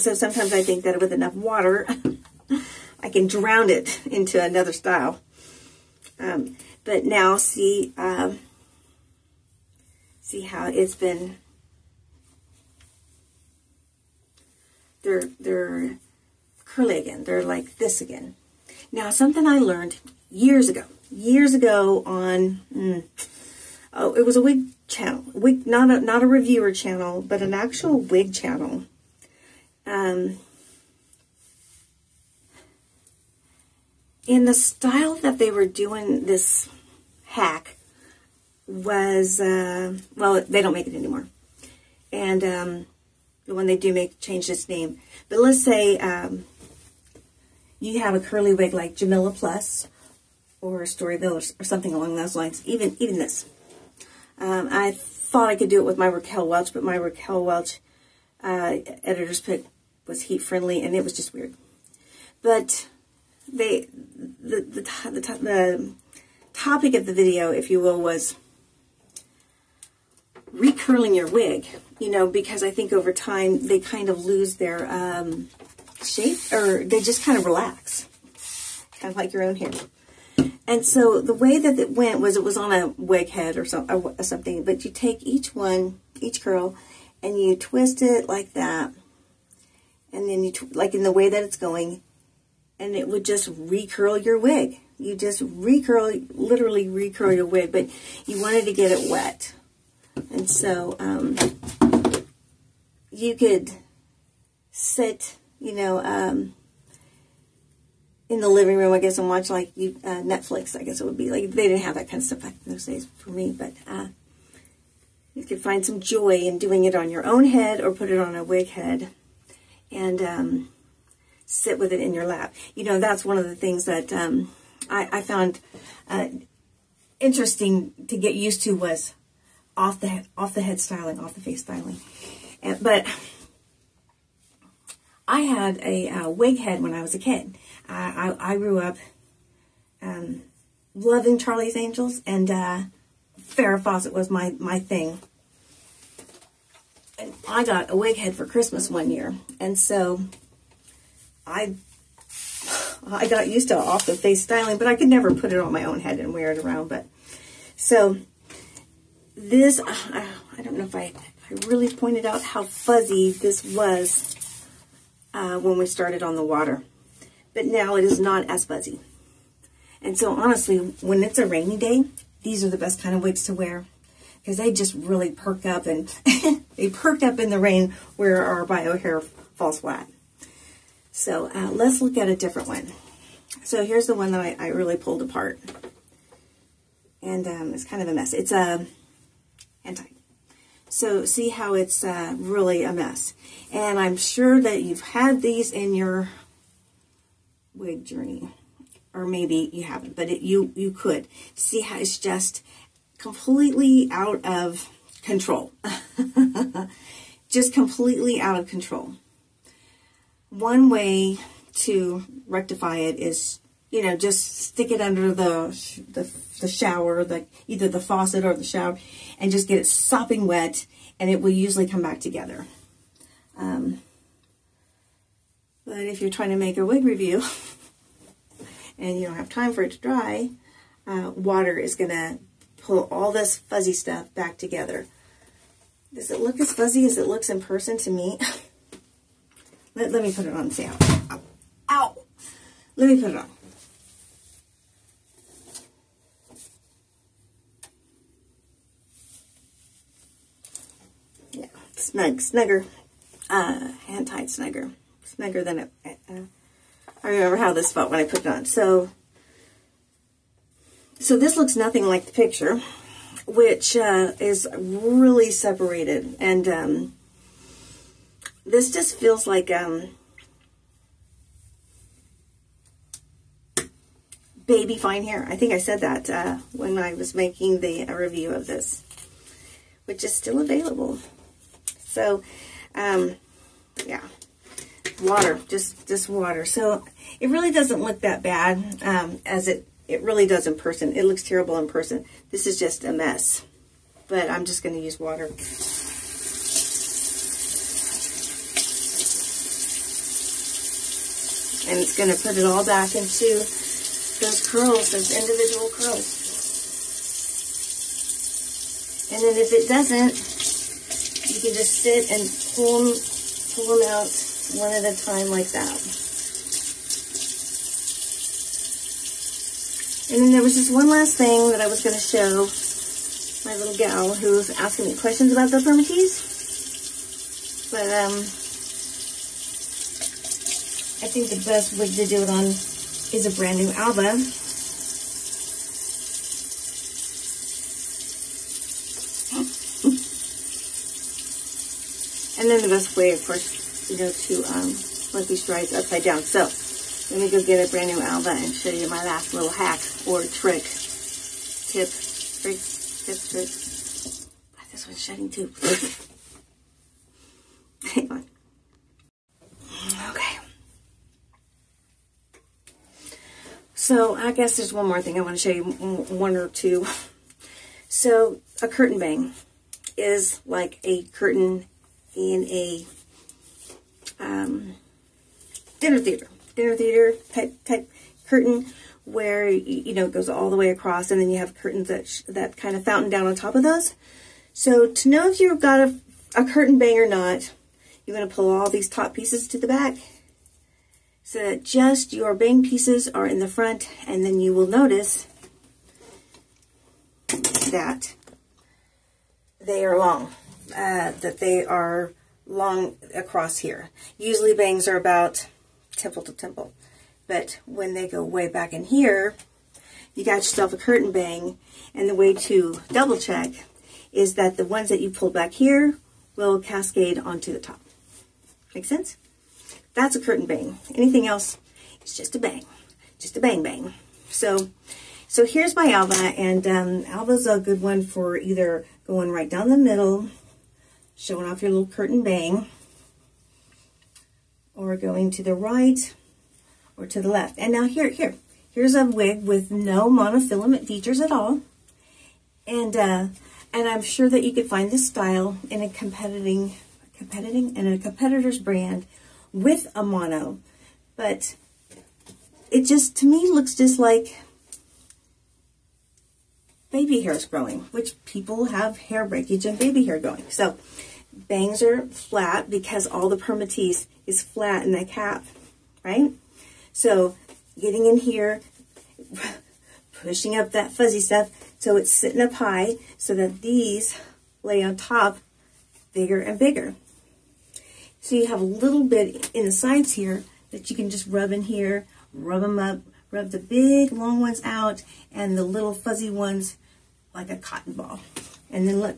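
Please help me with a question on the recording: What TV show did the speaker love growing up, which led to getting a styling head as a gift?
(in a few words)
Charlie's Angels.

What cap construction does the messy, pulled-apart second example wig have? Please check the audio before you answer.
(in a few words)
Hand tied.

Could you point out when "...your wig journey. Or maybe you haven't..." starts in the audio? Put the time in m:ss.
3:15.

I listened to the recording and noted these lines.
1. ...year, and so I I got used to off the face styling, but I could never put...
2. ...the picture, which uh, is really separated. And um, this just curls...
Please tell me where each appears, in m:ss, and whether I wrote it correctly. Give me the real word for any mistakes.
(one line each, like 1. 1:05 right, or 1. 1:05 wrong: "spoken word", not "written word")
1. 2:29 right
2. 4:22 wrong: "feels", not "curls".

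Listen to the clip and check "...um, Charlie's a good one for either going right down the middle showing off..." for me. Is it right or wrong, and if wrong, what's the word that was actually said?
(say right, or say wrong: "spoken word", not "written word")
wrong: "Alva", not "Charlie".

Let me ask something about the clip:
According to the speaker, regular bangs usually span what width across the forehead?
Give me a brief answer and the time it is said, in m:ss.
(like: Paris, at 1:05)
Temple to temple, at 6:46.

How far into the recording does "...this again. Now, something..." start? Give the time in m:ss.
0:17.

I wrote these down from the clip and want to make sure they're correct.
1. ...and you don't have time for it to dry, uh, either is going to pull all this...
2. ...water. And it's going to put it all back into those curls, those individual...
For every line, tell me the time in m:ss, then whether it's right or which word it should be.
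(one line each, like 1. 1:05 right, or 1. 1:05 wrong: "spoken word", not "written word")
1. 3:48 wrong: "water", not "either"
2. 4:55 right.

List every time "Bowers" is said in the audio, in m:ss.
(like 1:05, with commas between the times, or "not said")
not said.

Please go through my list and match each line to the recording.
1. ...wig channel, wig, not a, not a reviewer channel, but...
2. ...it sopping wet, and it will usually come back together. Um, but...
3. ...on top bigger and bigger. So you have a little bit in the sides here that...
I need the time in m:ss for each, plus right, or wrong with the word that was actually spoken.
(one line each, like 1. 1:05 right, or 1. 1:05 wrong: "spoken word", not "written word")
1. 0:24 right
2. 3:39 right
3. 7:55 right.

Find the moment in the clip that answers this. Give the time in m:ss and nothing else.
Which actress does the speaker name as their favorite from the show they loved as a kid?
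2:23.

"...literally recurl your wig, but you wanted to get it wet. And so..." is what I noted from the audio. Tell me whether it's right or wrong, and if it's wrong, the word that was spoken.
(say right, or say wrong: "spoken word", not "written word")
right.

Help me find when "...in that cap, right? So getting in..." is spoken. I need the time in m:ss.
7:45.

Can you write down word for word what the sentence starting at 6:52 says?
And the way to double check is that the ones that you pull back here will cascade onto the top.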